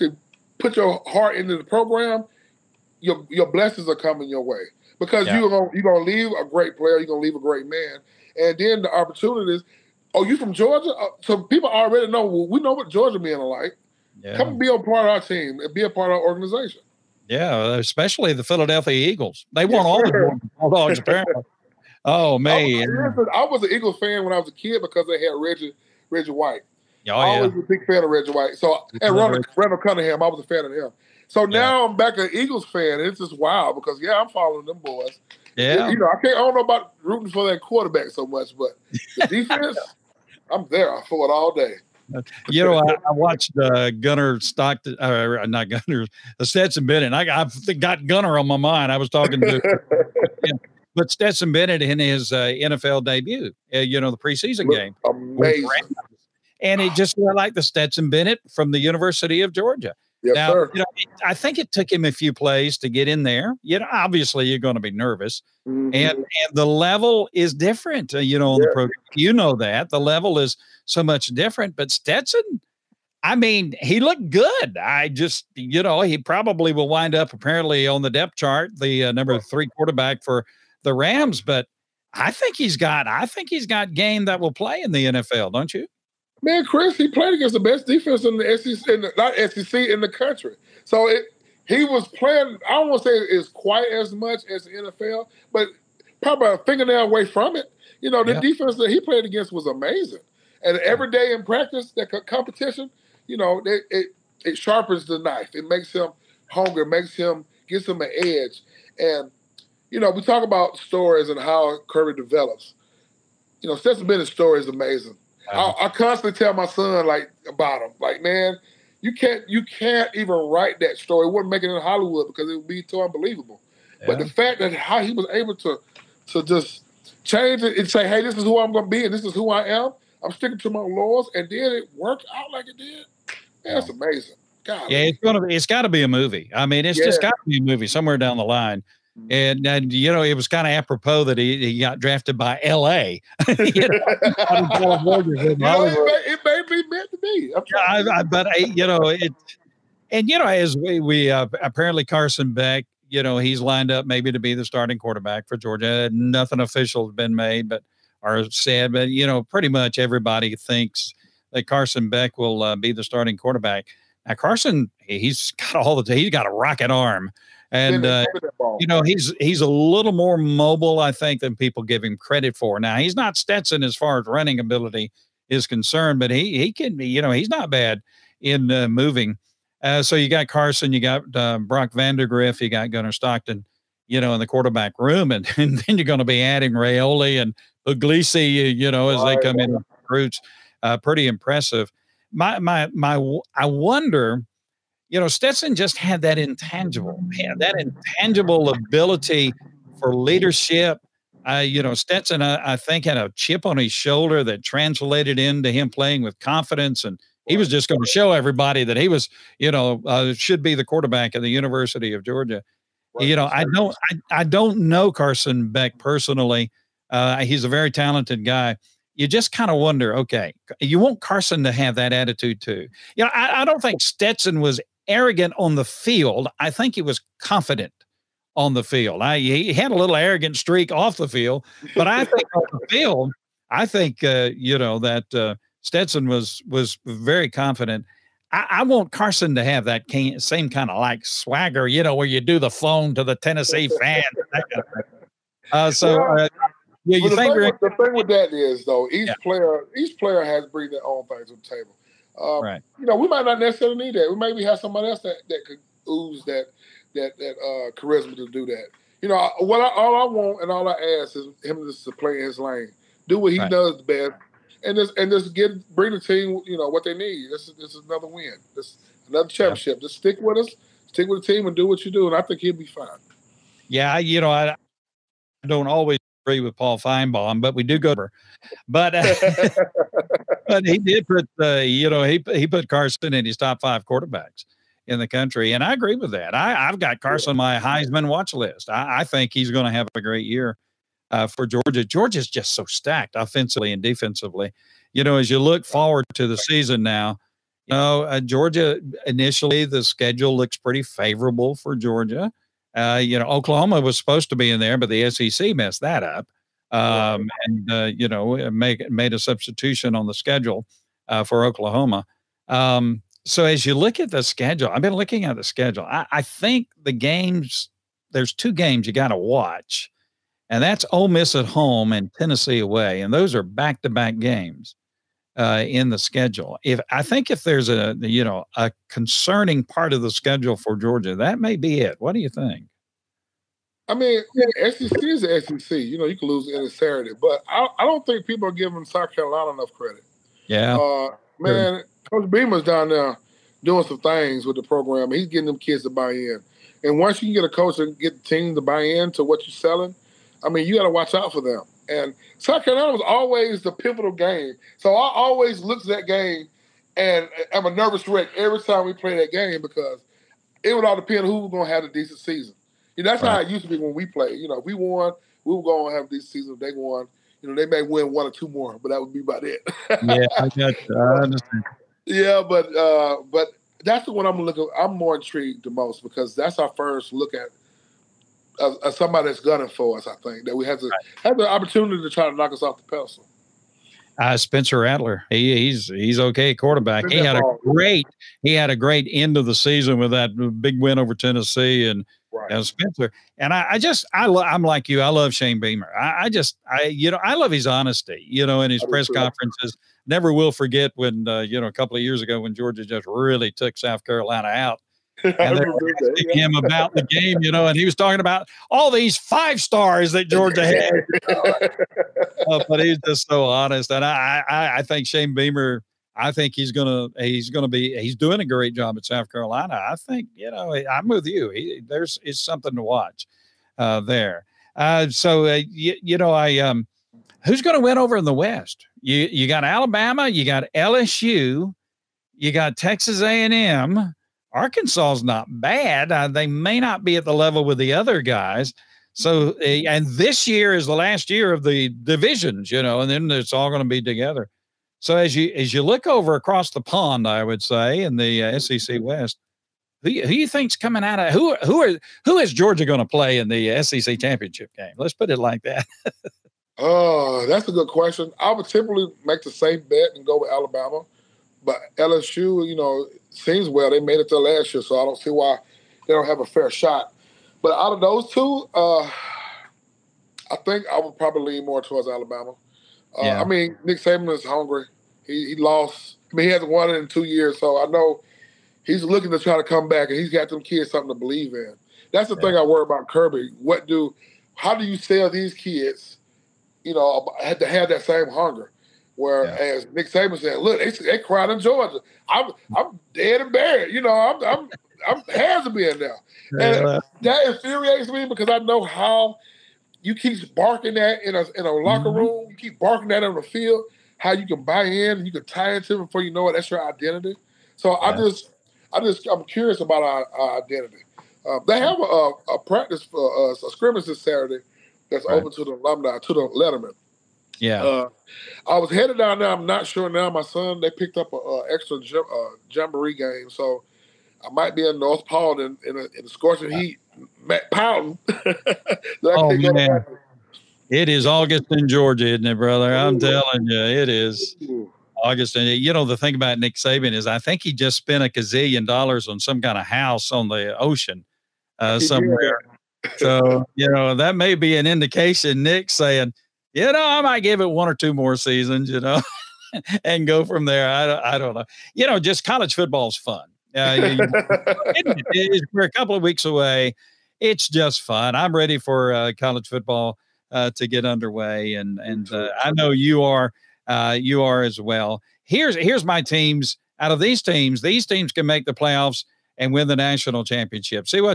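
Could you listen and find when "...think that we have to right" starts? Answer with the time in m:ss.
6:20.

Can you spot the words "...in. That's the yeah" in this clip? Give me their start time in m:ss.
8:01.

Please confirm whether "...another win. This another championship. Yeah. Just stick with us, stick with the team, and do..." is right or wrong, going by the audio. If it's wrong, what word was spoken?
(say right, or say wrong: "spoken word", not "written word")
right.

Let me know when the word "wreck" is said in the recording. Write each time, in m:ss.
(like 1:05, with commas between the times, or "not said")
5:58.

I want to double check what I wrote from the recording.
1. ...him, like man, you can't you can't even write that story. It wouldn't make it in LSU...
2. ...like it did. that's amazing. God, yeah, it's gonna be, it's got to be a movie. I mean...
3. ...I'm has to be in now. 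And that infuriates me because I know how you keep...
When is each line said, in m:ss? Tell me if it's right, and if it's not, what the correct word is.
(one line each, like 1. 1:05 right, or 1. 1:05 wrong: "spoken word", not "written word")
1. 1:57 wrong: "Hollywood", not "LSU"
2. 2:12 right
3. 8:15 right.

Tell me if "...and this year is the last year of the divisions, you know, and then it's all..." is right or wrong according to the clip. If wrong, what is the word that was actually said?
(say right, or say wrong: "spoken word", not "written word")
right.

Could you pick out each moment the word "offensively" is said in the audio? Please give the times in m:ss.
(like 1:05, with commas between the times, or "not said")
4:53.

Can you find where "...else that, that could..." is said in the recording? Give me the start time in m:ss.
4:15.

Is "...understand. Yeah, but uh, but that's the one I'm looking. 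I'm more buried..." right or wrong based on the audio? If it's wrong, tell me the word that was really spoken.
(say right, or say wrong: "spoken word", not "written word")
wrong: "intrigued", not "buried".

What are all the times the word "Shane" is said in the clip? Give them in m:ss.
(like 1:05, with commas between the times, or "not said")
6:35, 6:55.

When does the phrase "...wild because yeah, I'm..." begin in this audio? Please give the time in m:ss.
0:33.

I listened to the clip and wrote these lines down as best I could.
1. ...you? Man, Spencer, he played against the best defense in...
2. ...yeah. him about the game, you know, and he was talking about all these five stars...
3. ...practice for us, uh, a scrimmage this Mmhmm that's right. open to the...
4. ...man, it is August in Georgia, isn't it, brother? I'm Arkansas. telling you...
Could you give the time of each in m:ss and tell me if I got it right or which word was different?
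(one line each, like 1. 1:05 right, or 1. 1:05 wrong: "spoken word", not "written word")
1. 1:25 wrong: "Chris", not "Spencer"
2. 6:46 right
3. 8:32 wrong: "Saturday", not "Mmhmm"
4. 8:49 wrong: "Ooh", not "Arkansas".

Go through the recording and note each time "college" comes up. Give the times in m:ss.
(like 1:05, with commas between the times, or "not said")
9:12, 9:19.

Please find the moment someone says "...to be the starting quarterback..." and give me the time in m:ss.
2:34.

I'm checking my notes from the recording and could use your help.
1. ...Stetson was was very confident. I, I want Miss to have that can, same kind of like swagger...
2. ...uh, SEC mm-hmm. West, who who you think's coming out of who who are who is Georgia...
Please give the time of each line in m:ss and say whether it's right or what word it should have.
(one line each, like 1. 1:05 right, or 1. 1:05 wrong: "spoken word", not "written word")
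1. 3:55 wrong: "Carson", not "Miss"
2. 7:28 right.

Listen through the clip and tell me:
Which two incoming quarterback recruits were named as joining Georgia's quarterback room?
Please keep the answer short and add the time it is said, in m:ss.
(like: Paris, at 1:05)
Raiola and Puglisi, at 3:06.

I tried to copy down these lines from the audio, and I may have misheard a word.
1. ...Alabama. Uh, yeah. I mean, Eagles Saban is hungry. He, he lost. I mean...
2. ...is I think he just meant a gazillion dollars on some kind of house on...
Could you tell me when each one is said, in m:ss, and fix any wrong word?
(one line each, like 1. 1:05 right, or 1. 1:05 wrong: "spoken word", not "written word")
1. 7:52 wrong: "Nick", not "Eagles"
2. 8:57 wrong: "spent", not "meant".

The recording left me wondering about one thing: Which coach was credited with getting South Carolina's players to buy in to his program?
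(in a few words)
Coach Beamer.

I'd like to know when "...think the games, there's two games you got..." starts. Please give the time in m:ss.
5:16.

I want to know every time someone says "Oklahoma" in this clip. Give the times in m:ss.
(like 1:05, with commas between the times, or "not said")
5:03, 5:11.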